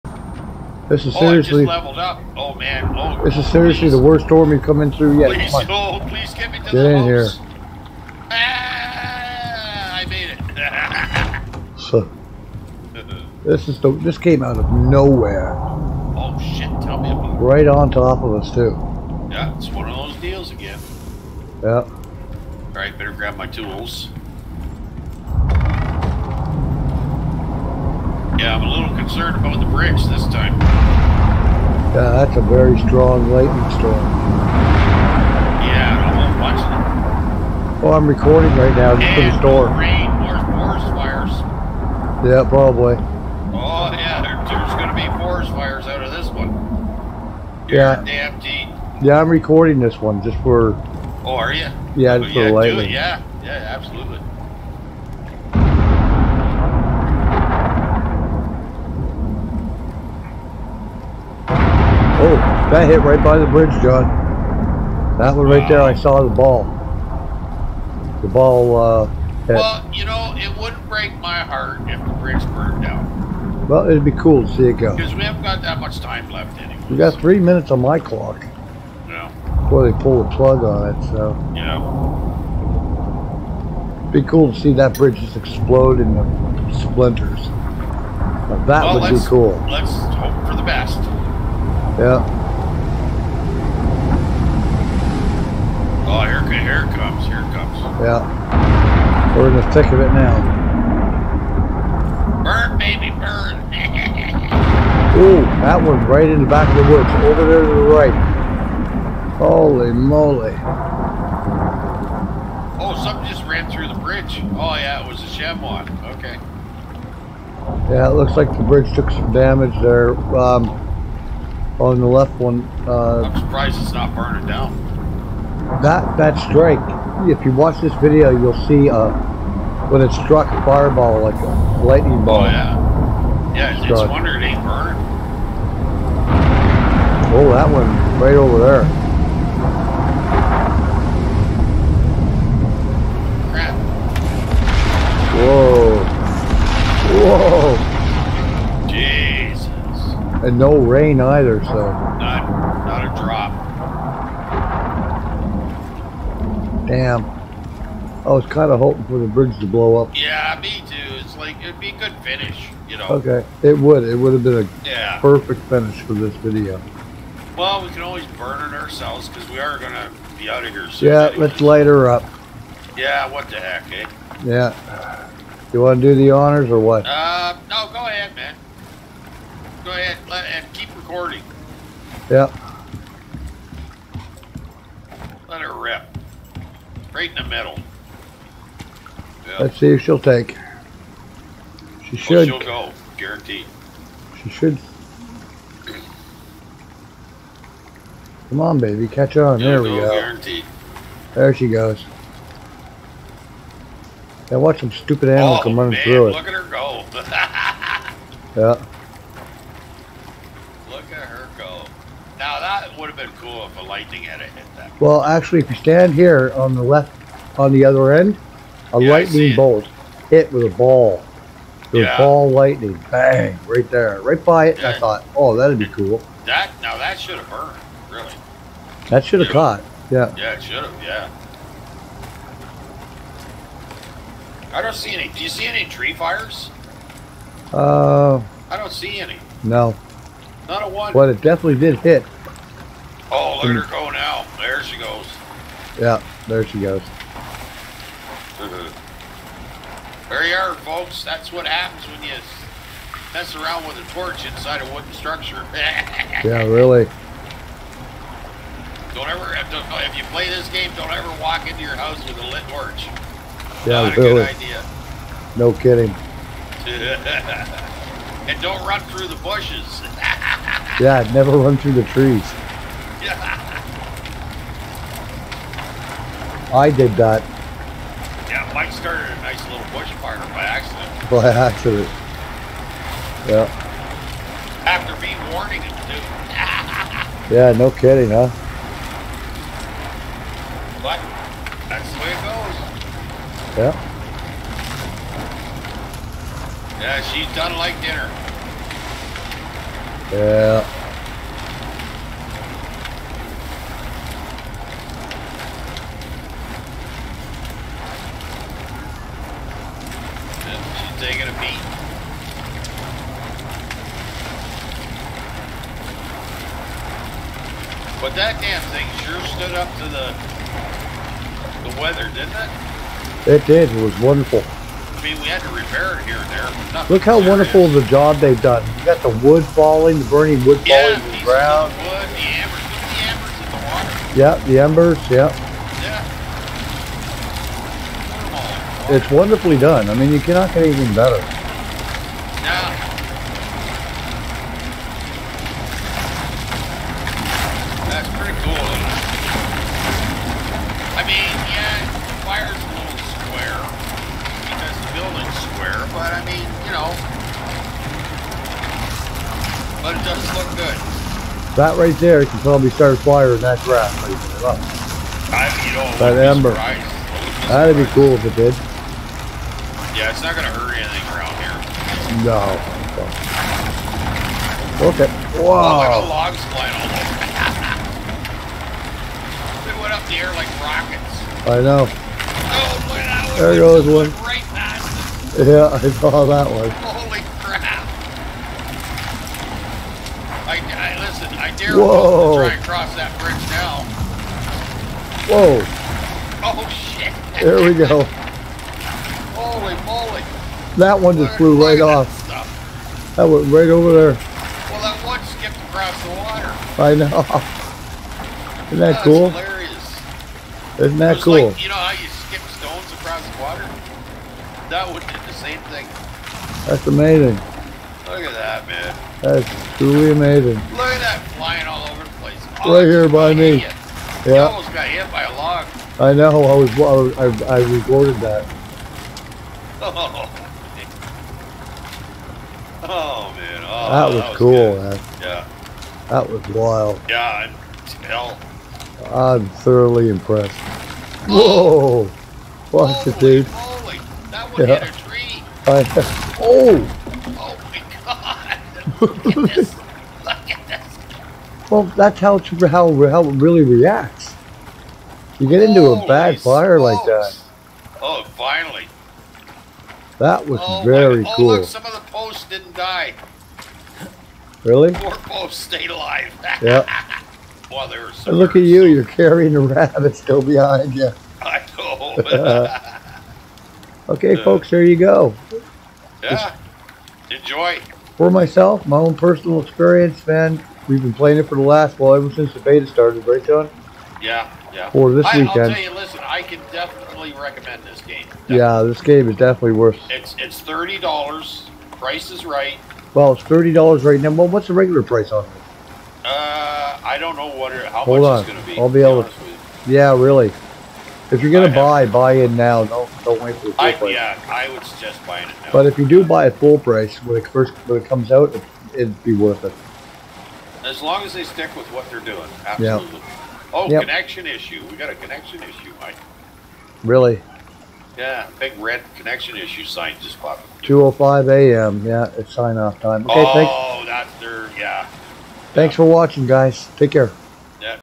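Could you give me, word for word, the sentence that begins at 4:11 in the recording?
That's what happens when you mess around with a torch inside a wooden structure.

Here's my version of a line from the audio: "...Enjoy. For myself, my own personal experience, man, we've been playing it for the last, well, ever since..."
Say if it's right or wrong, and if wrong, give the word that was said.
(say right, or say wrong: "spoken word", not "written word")
right.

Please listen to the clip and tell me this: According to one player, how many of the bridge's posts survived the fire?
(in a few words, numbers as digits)
4.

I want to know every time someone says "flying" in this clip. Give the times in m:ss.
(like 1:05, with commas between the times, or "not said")
6:16, 7:01.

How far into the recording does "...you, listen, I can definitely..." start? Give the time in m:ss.
8:06.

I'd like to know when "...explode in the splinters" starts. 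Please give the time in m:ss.
1:25.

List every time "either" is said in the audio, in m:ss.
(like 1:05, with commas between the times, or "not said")
2:31.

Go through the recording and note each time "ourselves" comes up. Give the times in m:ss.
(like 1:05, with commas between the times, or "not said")
2:48.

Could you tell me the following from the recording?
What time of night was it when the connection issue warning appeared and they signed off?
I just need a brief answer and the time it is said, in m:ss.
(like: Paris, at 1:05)
2:05 a.m., at 8:41.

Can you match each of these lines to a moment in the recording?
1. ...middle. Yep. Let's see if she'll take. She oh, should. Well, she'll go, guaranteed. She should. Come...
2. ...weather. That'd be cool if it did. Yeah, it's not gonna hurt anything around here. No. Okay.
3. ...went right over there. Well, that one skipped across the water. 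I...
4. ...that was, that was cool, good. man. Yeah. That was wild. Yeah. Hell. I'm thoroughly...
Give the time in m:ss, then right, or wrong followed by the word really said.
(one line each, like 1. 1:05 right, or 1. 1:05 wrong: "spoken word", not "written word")
1. 3:07 right
2. 6:06 wrong: "ember", not "weather"
3. 6:43 right
4. 7:13 right.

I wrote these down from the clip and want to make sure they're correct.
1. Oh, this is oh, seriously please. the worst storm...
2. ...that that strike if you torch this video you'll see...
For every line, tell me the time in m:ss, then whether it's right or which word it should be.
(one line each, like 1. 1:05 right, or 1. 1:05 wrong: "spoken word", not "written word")
1. 0:02 right
2. 2:05 wrong: "watch", not "torch".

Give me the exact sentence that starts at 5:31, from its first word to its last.
The wood, the embers, the embers in the water.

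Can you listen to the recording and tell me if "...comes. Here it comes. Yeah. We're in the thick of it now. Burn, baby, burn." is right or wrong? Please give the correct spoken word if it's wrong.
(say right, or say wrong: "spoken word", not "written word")
right.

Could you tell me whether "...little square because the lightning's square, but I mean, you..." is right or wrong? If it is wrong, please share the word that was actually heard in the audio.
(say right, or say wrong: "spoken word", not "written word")
wrong: "building", not "lightning".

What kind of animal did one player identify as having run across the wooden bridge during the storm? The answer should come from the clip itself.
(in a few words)
Chamois.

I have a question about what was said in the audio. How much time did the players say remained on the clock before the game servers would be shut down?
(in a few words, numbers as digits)
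3 minutes.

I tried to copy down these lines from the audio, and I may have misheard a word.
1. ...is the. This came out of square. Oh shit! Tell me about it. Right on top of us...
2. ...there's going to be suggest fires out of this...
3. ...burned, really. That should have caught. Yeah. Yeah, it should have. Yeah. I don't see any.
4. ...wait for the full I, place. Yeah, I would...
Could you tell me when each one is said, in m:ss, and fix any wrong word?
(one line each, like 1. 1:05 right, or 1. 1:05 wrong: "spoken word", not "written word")
1. 0:13 wrong: "nowhere", not "square"
2. 0:44 wrong: "forest", not "suggest"
3. 3:47 right
4. 8:23 wrong: "price", not "place".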